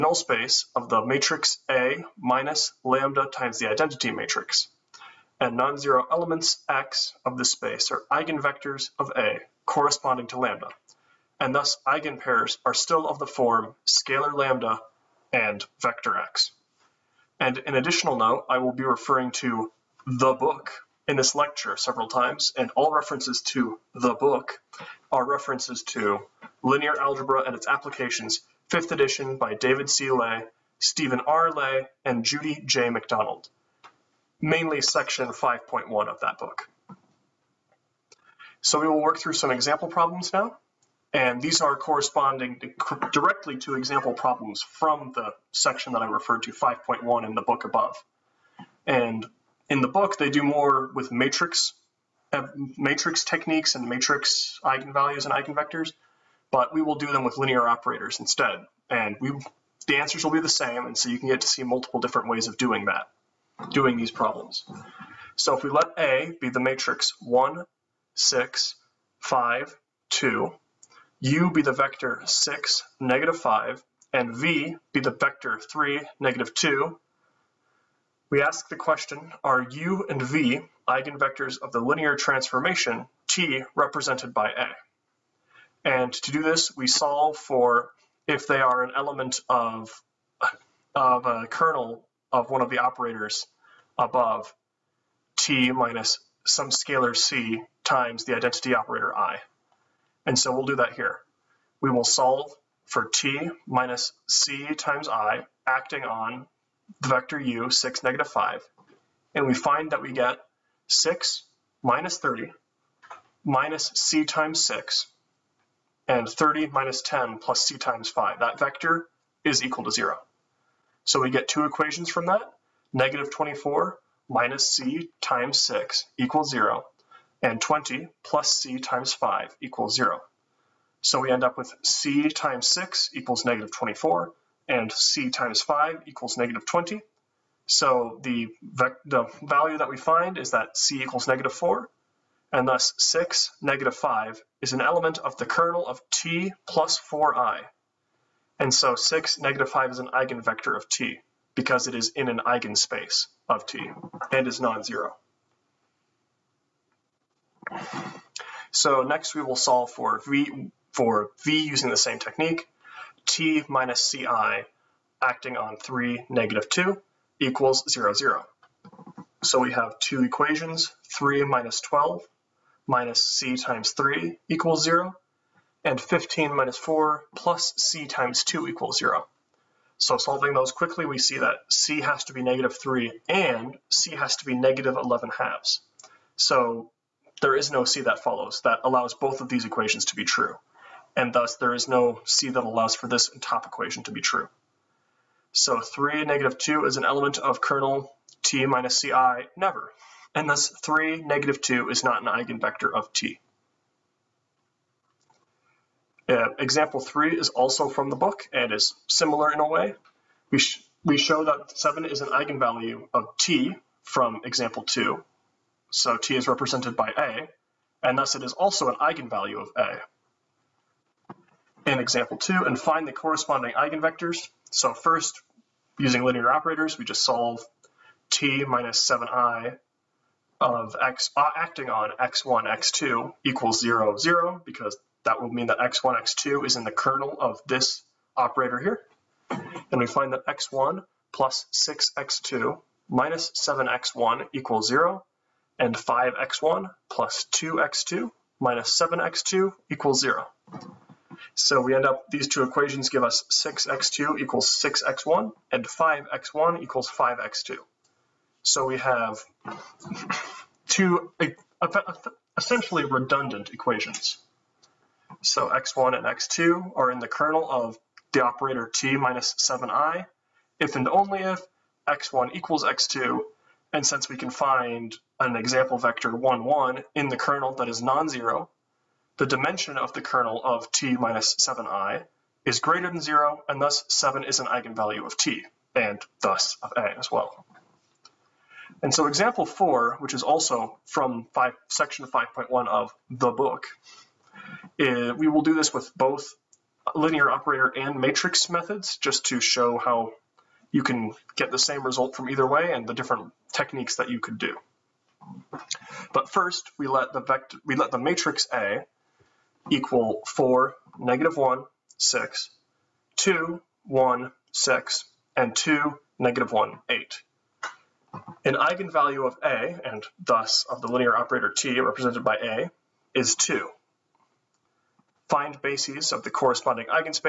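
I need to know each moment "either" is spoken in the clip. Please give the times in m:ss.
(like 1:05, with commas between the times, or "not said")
5:02.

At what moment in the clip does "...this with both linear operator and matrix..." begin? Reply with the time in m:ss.
4:55.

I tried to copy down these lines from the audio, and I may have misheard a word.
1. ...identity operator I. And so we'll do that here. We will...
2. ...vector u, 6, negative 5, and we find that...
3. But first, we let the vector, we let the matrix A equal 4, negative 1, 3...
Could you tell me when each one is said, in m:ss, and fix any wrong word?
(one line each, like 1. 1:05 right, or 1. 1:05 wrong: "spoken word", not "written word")
1. 1:38 right
2. 1:47 right
3. 5:06 wrong: "6", not "3".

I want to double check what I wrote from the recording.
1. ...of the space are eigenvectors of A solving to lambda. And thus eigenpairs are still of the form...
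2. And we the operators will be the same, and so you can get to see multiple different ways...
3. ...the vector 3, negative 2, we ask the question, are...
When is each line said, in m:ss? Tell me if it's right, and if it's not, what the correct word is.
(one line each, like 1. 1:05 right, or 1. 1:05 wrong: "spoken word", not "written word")
1. 0:07 wrong: "corresponding", not "solving"
2. 0:58 wrong: "answers", not "operators"
3. 1:15 right.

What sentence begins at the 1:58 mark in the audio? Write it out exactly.
That vector is equal to 0.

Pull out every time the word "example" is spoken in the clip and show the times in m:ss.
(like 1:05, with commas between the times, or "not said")
0:39, 0:43, 3:26, 3:34, 3:41, 4:35, 4:49.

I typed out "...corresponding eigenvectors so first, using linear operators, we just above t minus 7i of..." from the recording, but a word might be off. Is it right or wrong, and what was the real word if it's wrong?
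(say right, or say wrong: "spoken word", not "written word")
wrong: "solve", not "above".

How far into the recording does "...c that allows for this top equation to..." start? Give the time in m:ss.
3:12.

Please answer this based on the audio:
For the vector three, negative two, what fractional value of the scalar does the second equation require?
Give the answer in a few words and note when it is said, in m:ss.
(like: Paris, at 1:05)
-11/2, at 3:04.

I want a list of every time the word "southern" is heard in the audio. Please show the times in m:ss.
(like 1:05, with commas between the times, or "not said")
not said.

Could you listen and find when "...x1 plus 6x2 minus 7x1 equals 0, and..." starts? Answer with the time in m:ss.
4:00.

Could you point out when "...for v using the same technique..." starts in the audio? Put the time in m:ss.
2:40.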